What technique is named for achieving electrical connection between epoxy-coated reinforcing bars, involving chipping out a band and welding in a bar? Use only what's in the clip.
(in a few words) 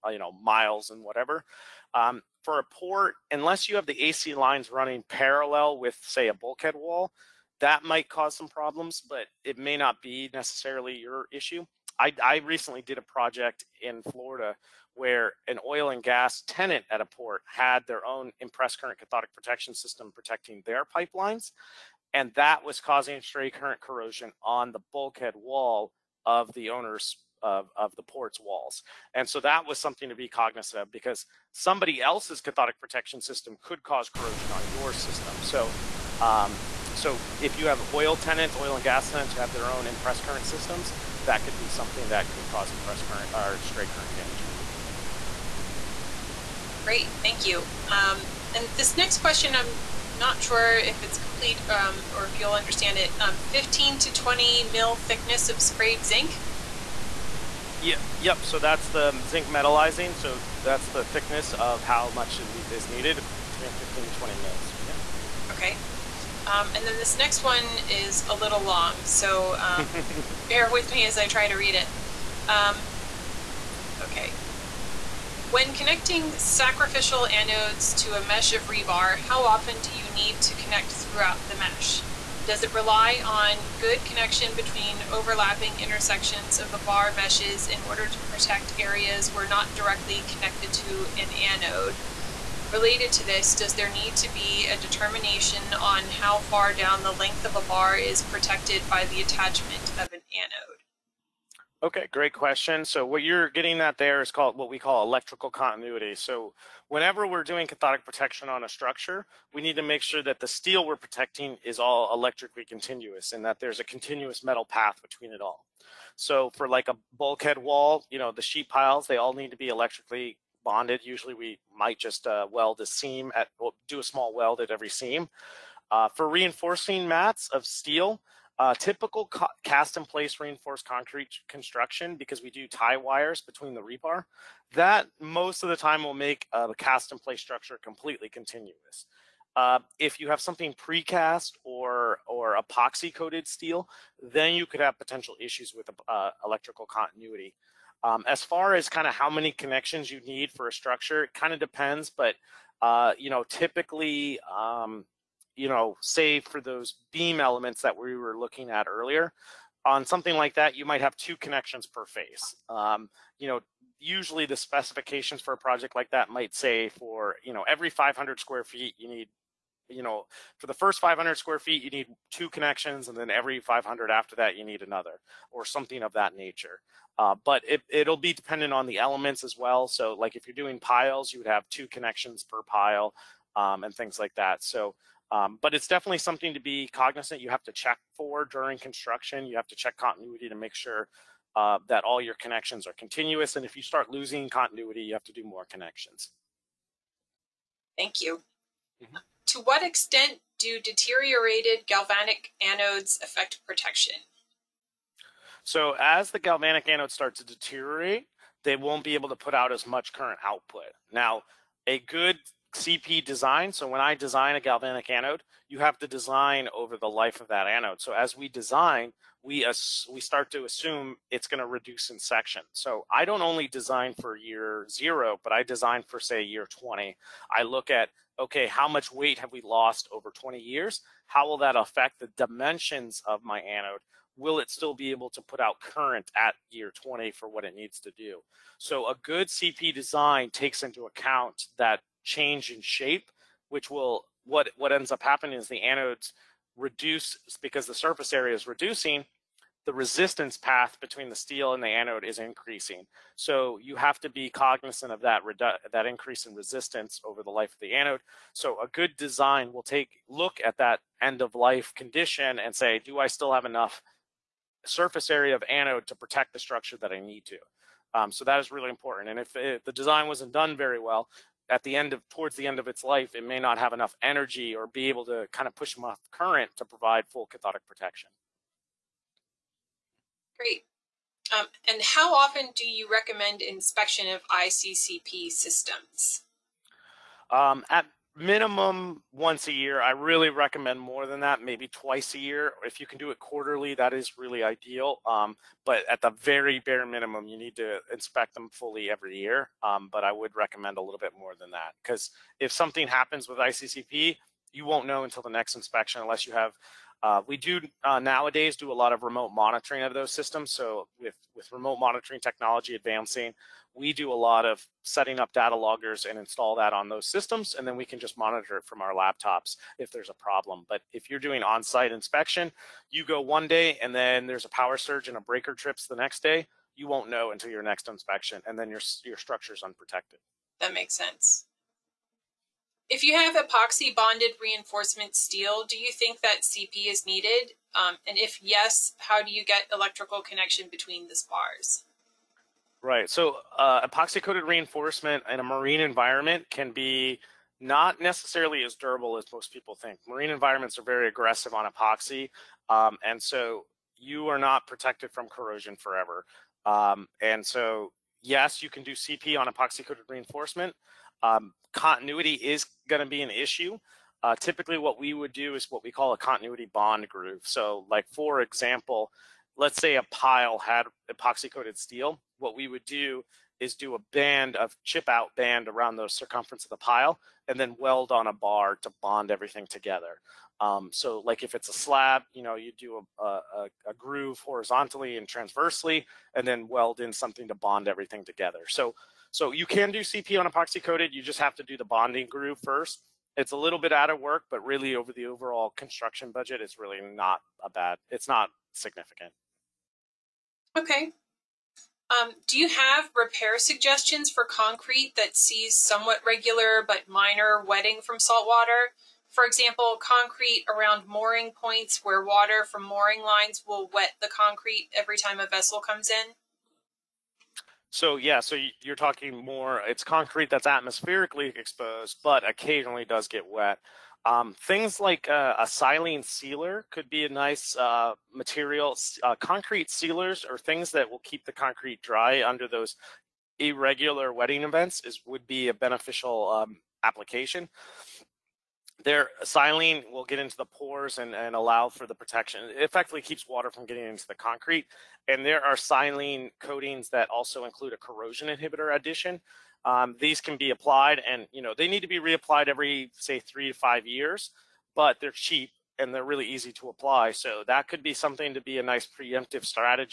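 Continuity bond groove.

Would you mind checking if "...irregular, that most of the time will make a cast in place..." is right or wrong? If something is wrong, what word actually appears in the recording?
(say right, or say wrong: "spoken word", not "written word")
wrong: "rebar", not "irregular".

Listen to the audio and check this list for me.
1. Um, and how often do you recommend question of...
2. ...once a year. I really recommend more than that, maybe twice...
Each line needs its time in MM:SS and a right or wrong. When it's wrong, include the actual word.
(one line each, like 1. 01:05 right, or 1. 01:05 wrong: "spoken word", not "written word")
1. 04:41 wrong: "inspection", not "question"
2. 04:49 right.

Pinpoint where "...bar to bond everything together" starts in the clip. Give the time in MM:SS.
06:18.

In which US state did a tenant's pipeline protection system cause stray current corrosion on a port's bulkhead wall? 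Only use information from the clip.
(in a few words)
Florida.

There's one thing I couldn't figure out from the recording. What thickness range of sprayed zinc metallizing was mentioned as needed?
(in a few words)
15 to 20 mils.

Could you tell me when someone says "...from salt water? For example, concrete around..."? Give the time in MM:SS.
06:48.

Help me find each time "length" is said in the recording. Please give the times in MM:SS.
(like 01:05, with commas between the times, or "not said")
01:37.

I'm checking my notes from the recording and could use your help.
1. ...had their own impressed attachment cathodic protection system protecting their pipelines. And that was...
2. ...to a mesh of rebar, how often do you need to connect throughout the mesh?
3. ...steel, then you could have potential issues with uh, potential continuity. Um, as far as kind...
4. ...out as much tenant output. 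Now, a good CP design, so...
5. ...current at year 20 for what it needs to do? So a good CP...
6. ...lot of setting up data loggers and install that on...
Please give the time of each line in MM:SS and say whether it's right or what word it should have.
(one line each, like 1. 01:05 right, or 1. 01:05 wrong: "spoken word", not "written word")
1. 00:17 wrong: "current", not "attachment"
2. 01:17 right
3. 02:23 wrong: "electrical", not "potential"
4. 03:29 wrong: "current", not "tenant"
5. 03:55 right
6. 05:14 right.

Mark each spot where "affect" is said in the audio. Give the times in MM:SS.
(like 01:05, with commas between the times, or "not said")
03:23, 03:51.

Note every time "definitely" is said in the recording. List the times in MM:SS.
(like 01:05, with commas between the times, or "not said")
03:05.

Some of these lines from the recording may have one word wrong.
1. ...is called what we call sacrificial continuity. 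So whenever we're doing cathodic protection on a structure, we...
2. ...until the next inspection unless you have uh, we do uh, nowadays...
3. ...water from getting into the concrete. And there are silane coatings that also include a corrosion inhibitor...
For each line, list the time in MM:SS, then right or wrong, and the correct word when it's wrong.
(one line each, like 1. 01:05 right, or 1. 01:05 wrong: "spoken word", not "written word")
1. 01:44 wrong: "electrical", not "sacrificial"
2. 05:05 right
3. 07:23 right.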